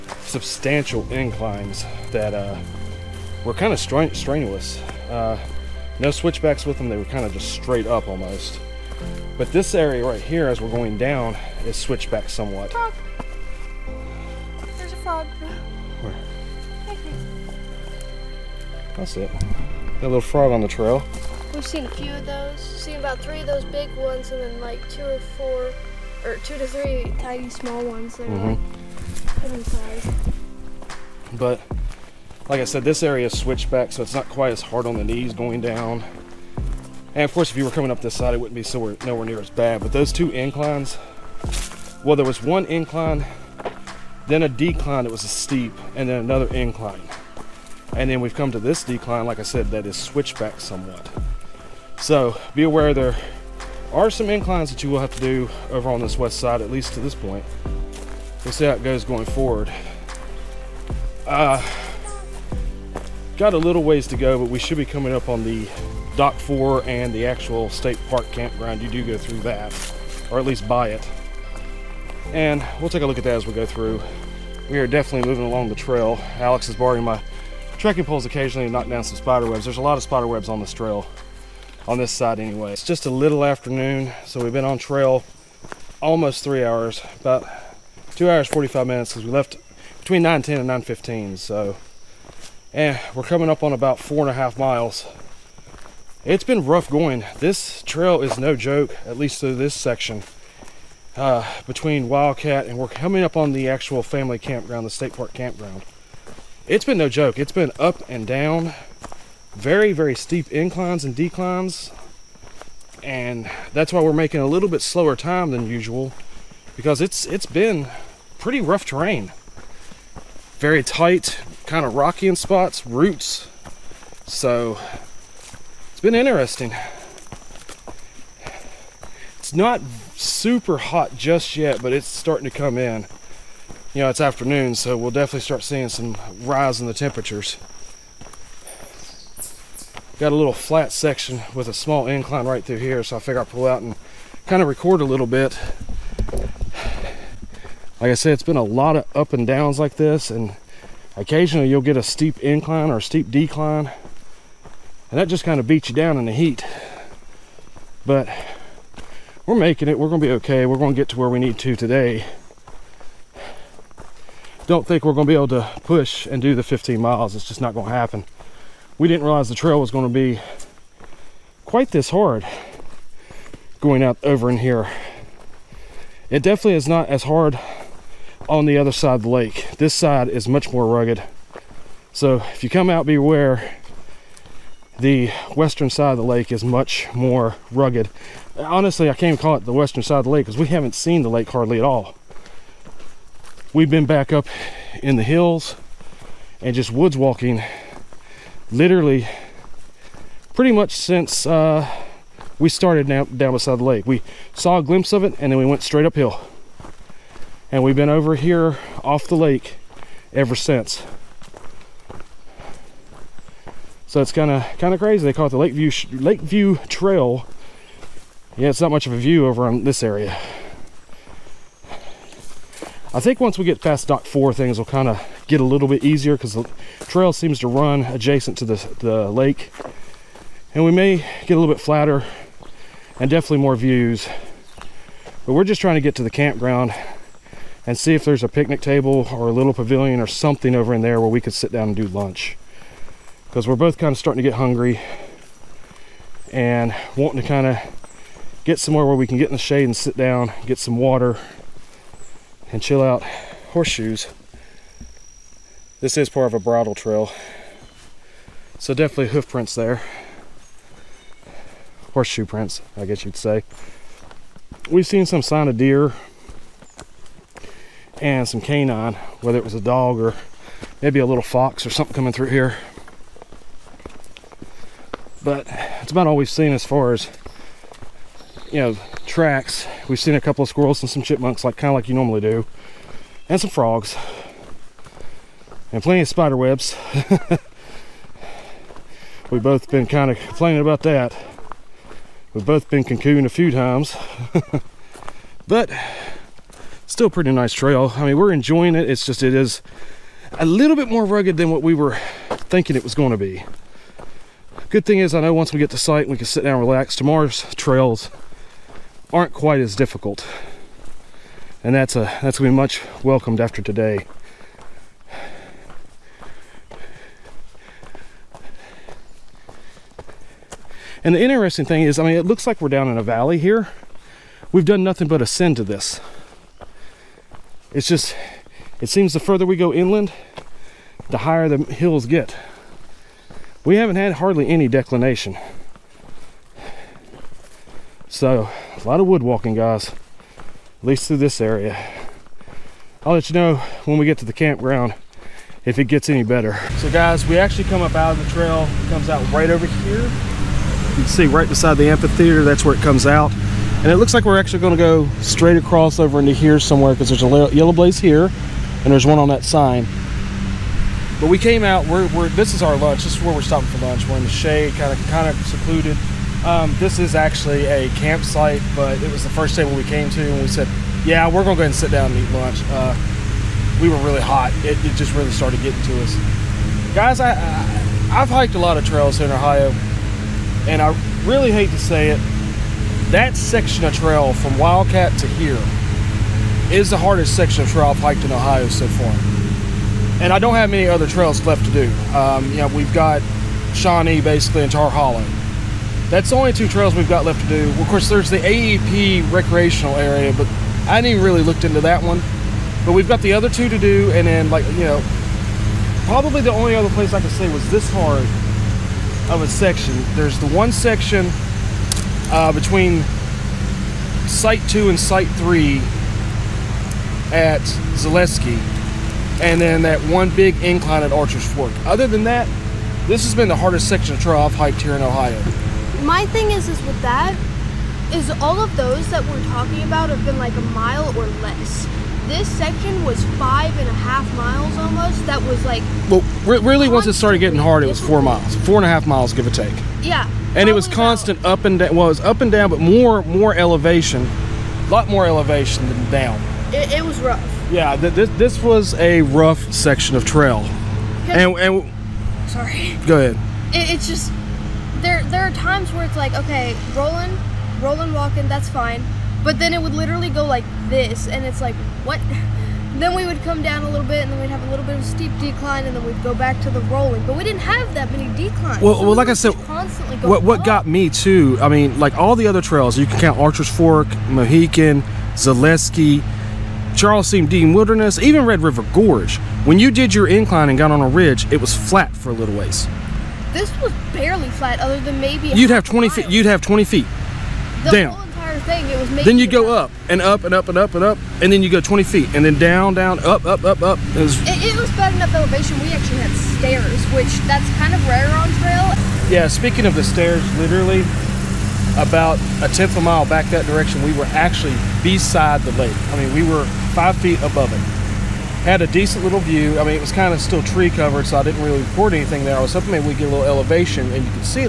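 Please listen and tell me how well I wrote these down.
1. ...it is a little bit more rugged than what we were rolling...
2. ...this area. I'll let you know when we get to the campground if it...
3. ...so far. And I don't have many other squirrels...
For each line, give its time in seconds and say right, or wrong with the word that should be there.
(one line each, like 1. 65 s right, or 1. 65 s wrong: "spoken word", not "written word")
1. 299 s wrong: "thinking", not "rolling"
2. 341 s right
3. 388 s wrong: "trails", not "squirrels".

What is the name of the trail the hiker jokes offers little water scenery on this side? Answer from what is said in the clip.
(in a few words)
Lakeview Trail.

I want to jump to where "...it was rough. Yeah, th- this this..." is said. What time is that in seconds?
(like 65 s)
447 s.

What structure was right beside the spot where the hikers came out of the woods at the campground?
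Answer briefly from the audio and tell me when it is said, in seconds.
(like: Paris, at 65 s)
the amphitheater, at 351 s.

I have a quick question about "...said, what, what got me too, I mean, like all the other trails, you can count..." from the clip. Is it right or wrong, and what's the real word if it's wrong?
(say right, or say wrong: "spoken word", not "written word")
right.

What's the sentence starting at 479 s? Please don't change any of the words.
When you did your incline and got on a ridge, it was flat for a little ways.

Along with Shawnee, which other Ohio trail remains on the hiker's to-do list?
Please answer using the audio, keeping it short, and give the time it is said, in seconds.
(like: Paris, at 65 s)
Tar Hollow, at 394 s.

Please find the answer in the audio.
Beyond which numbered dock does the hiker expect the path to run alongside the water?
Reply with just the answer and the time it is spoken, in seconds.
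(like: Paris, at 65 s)
Dock 4, at 224 s.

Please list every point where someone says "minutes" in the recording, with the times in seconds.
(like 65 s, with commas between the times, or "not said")
88 s.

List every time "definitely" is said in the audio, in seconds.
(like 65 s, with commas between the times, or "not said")
74 s, 135 s, 176 s, 233 s, 258 s.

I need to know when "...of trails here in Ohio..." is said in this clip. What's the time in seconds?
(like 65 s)
378 s.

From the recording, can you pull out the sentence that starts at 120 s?
Very tight, kind of rocky in spots, roots.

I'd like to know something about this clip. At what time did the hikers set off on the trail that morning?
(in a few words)
between 9:10 and 9:15.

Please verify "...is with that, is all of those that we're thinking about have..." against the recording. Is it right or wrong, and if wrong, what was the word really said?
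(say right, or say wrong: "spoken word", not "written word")
wrong: "talking", not "thinking".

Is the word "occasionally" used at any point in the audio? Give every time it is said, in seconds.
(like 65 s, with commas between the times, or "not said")
78 s, 151 s.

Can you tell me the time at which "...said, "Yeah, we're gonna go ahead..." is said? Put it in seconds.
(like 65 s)
370 s.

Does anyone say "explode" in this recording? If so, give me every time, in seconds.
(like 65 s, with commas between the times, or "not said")
not said.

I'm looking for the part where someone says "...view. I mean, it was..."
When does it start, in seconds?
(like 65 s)
509 s.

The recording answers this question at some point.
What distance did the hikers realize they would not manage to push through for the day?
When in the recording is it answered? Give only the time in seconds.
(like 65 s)
166 s.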